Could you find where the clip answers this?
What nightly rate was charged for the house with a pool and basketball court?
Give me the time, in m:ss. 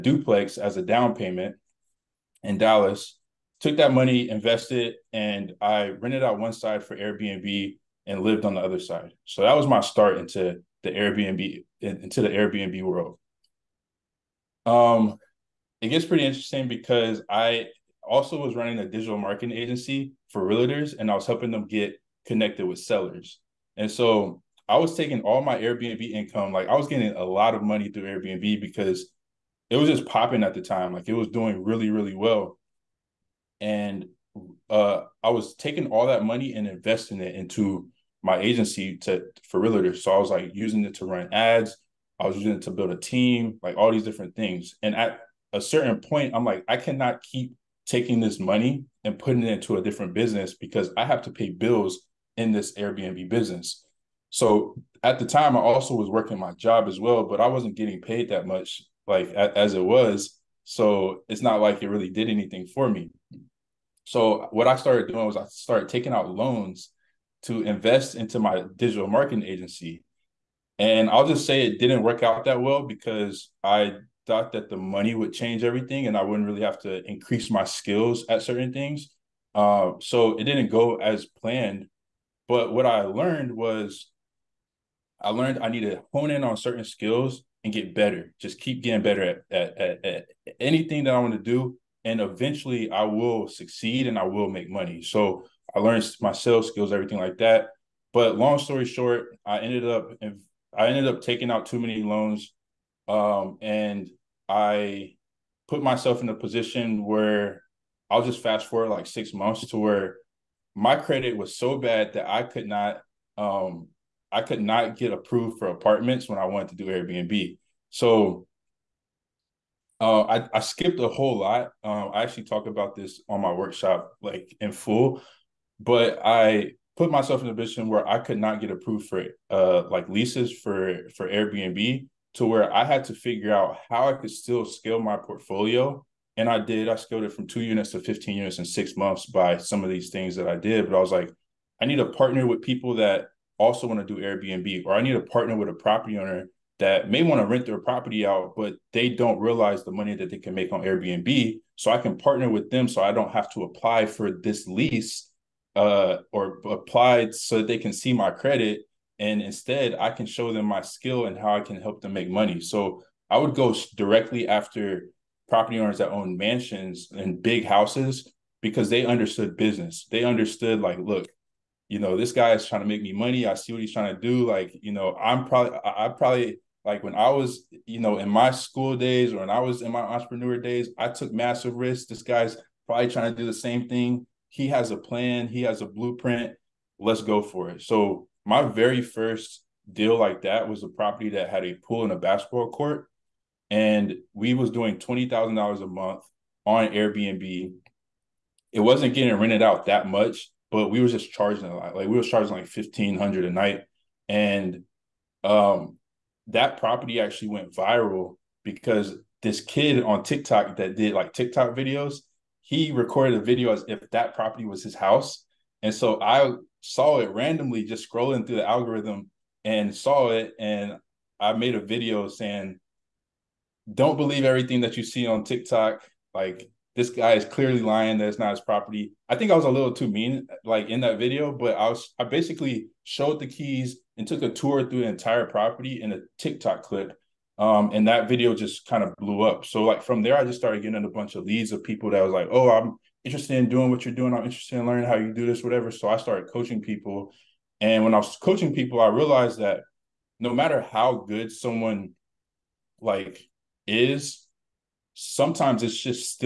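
3:22.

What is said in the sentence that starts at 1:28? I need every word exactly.
Just keep getting better at, at, at, at anything that I want to do.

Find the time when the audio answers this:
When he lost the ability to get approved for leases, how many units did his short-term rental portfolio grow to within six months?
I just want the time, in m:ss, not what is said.
2:18.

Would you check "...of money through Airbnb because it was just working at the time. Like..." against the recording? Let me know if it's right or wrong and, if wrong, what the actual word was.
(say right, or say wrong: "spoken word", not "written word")
wrong: "popping", not "working".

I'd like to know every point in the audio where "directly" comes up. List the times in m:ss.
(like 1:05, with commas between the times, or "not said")
2:43.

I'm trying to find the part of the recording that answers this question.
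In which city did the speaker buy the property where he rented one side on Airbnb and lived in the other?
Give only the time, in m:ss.
0:02.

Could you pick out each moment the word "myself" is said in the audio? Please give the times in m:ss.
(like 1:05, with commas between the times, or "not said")
1:45, 2:07.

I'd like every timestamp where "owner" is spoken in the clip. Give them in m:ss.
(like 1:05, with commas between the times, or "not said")
2:26, 2:45.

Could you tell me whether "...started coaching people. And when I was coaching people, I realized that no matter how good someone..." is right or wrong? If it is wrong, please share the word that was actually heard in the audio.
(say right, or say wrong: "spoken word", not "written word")
right.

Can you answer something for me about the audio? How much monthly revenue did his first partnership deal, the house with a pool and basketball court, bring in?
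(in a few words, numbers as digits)
$20,000.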